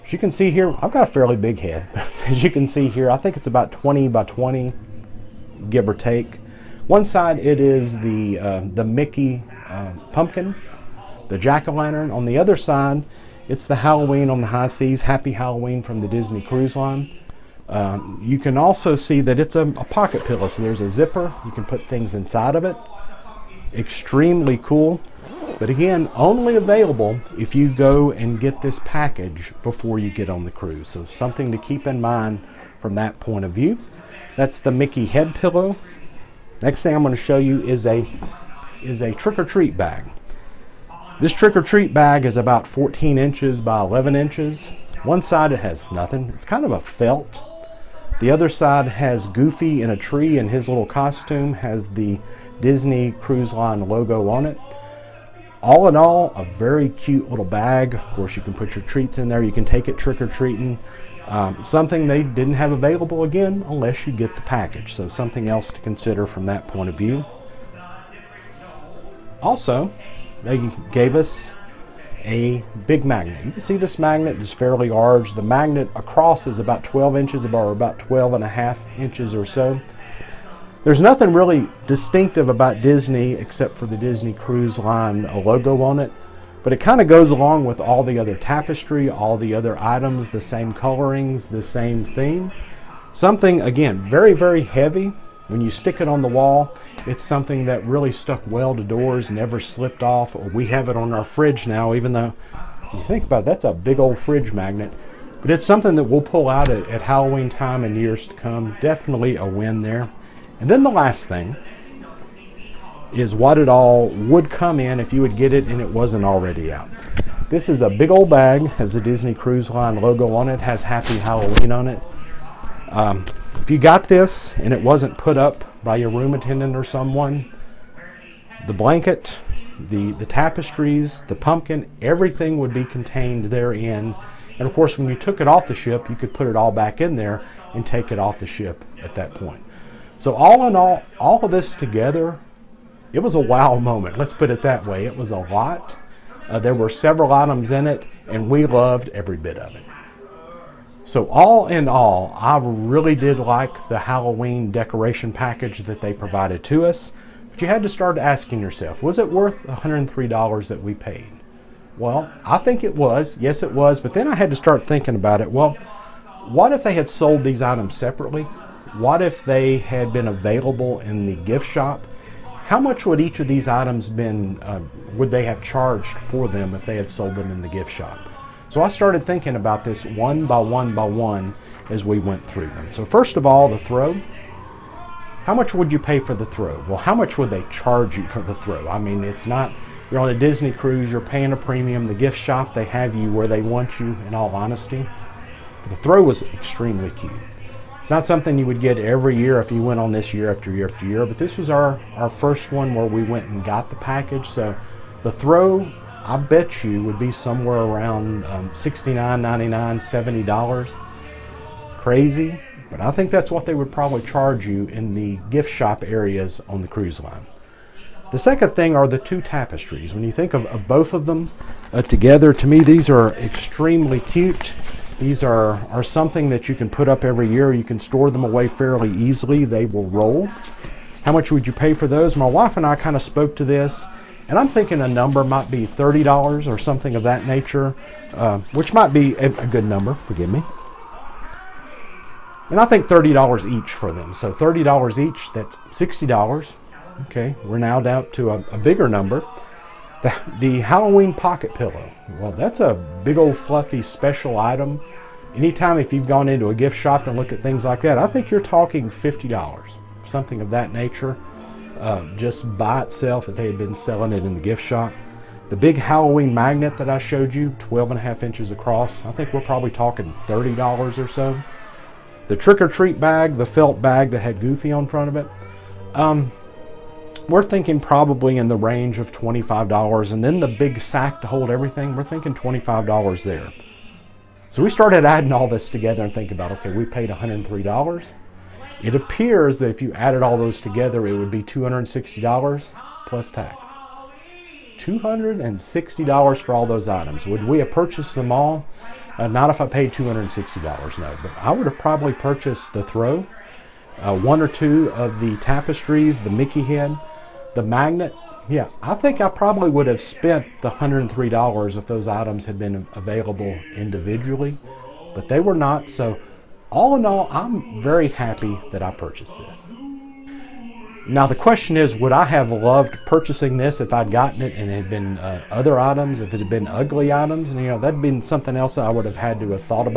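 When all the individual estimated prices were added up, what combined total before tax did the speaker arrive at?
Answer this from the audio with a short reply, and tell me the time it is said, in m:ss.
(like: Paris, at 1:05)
$260, at 4:51.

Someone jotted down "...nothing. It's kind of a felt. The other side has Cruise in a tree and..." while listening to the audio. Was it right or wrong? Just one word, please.
wrong.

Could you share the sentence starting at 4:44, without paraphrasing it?
So we started adding all this together and thinking about, okay, we paid $103.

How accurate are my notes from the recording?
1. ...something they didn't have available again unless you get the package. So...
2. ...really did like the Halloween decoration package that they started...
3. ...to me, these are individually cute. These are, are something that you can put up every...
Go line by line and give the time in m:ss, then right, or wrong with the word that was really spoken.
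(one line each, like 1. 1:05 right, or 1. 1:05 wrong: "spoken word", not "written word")
1. 1:01 right
2. 2:32 wrong: "provided", not "started"
3. 3:42 wrong: "extremely", not "individually".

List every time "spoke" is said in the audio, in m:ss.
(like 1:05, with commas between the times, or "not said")
3:53.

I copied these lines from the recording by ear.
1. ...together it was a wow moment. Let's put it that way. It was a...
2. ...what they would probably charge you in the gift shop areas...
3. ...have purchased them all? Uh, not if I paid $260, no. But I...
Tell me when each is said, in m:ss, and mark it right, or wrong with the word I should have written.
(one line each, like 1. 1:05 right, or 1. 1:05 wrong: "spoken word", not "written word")
1. 2:21 right
2. 3:33 right
3. 4:57 right.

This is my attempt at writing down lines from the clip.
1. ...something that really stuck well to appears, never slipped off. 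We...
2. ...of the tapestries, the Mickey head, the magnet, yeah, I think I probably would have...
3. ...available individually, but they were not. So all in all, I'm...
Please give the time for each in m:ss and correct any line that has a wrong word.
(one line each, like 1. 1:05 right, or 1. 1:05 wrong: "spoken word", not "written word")
1. 1:37 wrong: "doors", not "appears"
2. 5:05 right
3. 5:13 right.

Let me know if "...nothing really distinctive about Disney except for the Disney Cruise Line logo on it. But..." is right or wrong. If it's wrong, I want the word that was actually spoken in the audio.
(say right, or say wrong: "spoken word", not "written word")
right.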